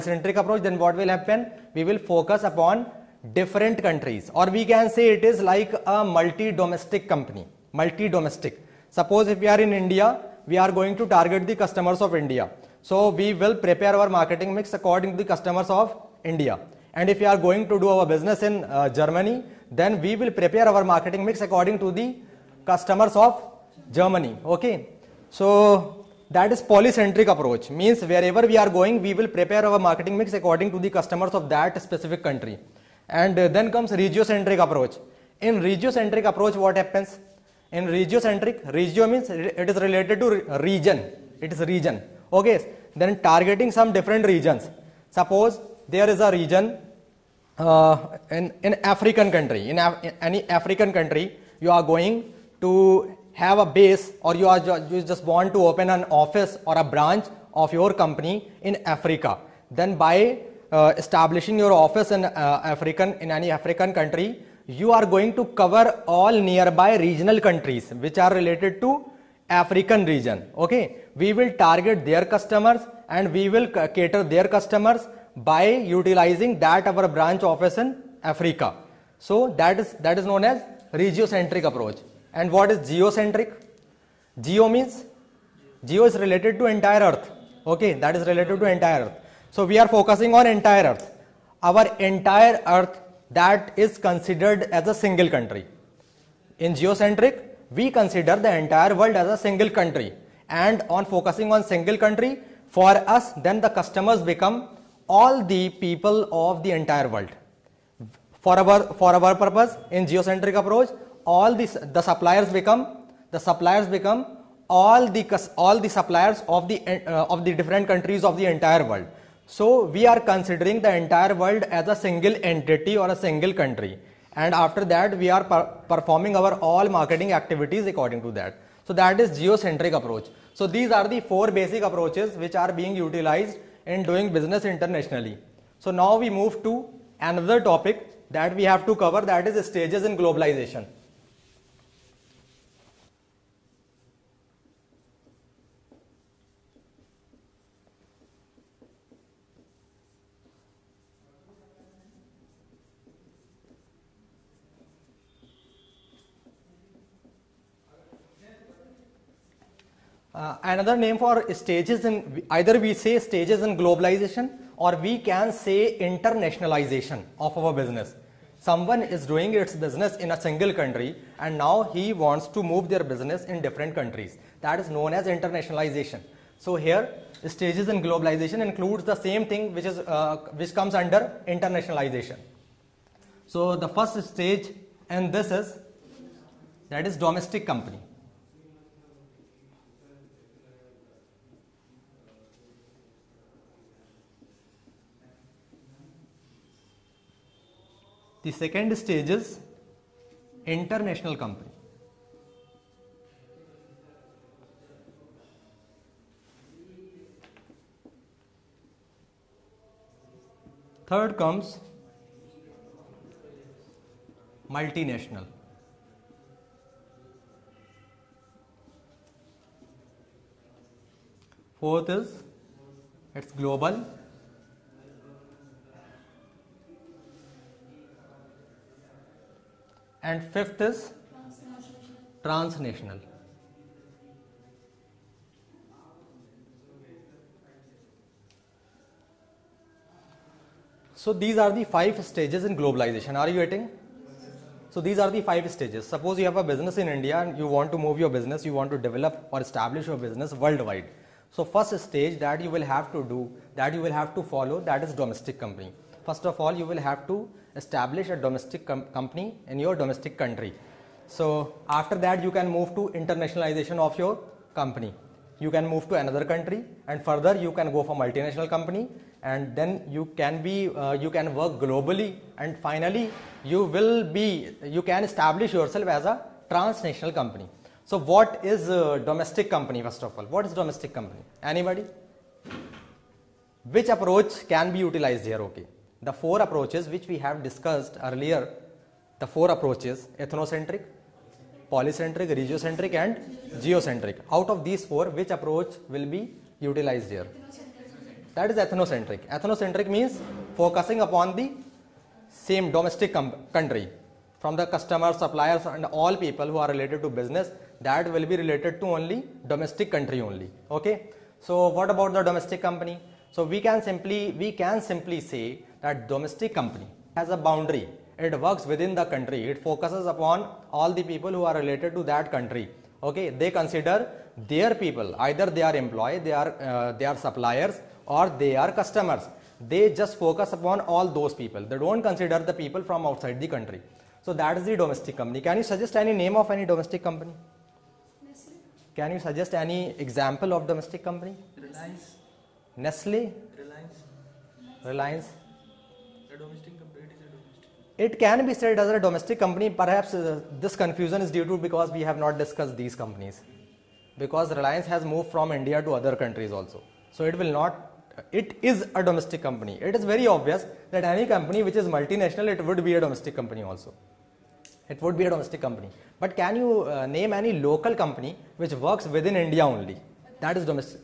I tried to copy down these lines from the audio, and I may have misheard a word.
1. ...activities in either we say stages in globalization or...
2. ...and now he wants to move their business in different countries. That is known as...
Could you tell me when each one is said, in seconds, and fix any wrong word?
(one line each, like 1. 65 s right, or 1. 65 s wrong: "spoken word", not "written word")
1. 161 s wrong: "stages", not "activities"
2. 171 s right.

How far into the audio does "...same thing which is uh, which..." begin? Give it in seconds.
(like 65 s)
179 s.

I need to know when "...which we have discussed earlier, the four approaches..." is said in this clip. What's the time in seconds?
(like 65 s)
287 s.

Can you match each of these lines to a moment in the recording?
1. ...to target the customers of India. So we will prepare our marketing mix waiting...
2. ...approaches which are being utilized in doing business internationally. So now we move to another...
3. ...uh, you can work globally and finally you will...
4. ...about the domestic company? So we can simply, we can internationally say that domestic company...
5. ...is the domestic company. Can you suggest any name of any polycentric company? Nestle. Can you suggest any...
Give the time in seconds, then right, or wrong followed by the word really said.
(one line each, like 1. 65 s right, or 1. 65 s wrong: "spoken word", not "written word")
1. 10 s wrong: "according", not "waiting"
2. 131 s right
3. 271 s right
4. 312 s wrong: "simply", not "internationally"
5. 334 s wrong: "domestic", not "polycentric".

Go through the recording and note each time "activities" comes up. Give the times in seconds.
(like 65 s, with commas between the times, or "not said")
127 s.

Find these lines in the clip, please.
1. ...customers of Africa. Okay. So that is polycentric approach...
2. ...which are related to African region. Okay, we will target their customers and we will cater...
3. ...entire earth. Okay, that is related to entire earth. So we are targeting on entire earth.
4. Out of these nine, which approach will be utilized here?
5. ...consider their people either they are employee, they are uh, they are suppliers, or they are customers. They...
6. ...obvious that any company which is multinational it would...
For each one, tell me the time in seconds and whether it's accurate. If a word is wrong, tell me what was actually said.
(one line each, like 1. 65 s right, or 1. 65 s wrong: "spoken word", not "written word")
1. 22 s wrong: "Germany", not "Africa"
2. 67 s right
3. 86 s wrong: "focusing", not "targeting"
4. 294 s wrong: "four", not "nine"
5. 323 s right
6. 360 s right.